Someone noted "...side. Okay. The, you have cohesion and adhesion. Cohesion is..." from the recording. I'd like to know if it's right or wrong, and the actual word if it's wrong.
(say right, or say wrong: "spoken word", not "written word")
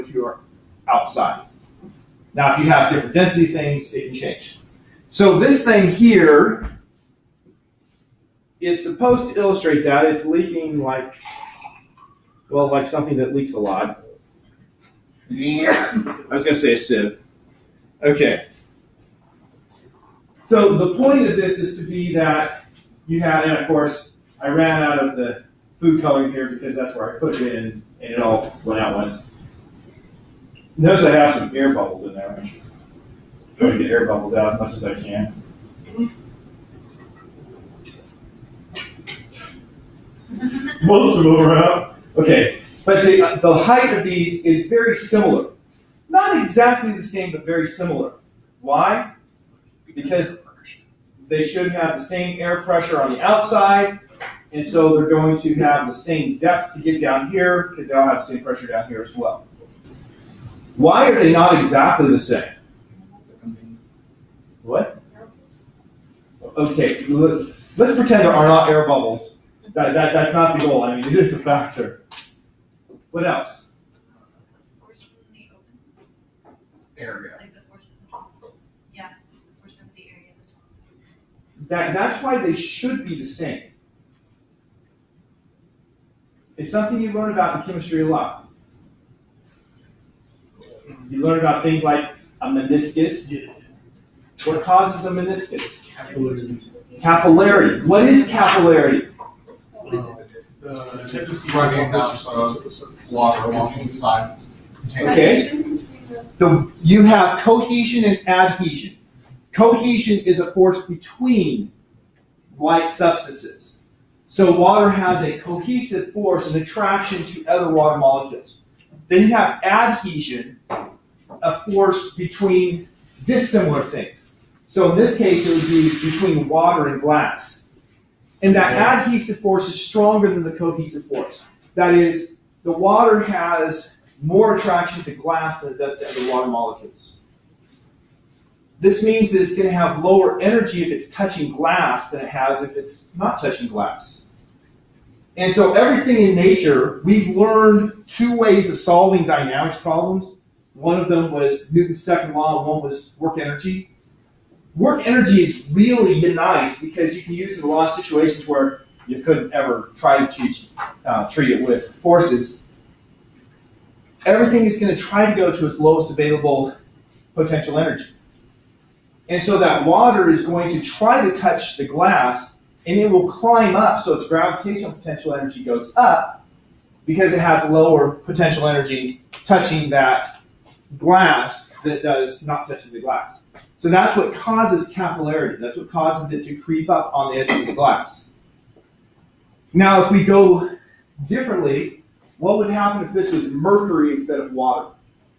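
right.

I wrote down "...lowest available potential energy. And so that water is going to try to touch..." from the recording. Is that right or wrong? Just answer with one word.
right.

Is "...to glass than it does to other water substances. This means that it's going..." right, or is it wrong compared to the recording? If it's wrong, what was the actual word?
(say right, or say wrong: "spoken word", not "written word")
wrong: "molecules", not "substances".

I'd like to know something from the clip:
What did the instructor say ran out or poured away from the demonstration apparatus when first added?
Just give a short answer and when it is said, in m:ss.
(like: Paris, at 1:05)
Food coloring, at 0:25.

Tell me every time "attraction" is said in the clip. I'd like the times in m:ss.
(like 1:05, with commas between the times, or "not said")
1:56, 2:14.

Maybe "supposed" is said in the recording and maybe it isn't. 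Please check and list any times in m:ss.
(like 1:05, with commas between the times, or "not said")
0:08.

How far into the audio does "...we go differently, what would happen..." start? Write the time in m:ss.
3:10.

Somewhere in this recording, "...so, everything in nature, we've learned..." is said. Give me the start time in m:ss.
2:25.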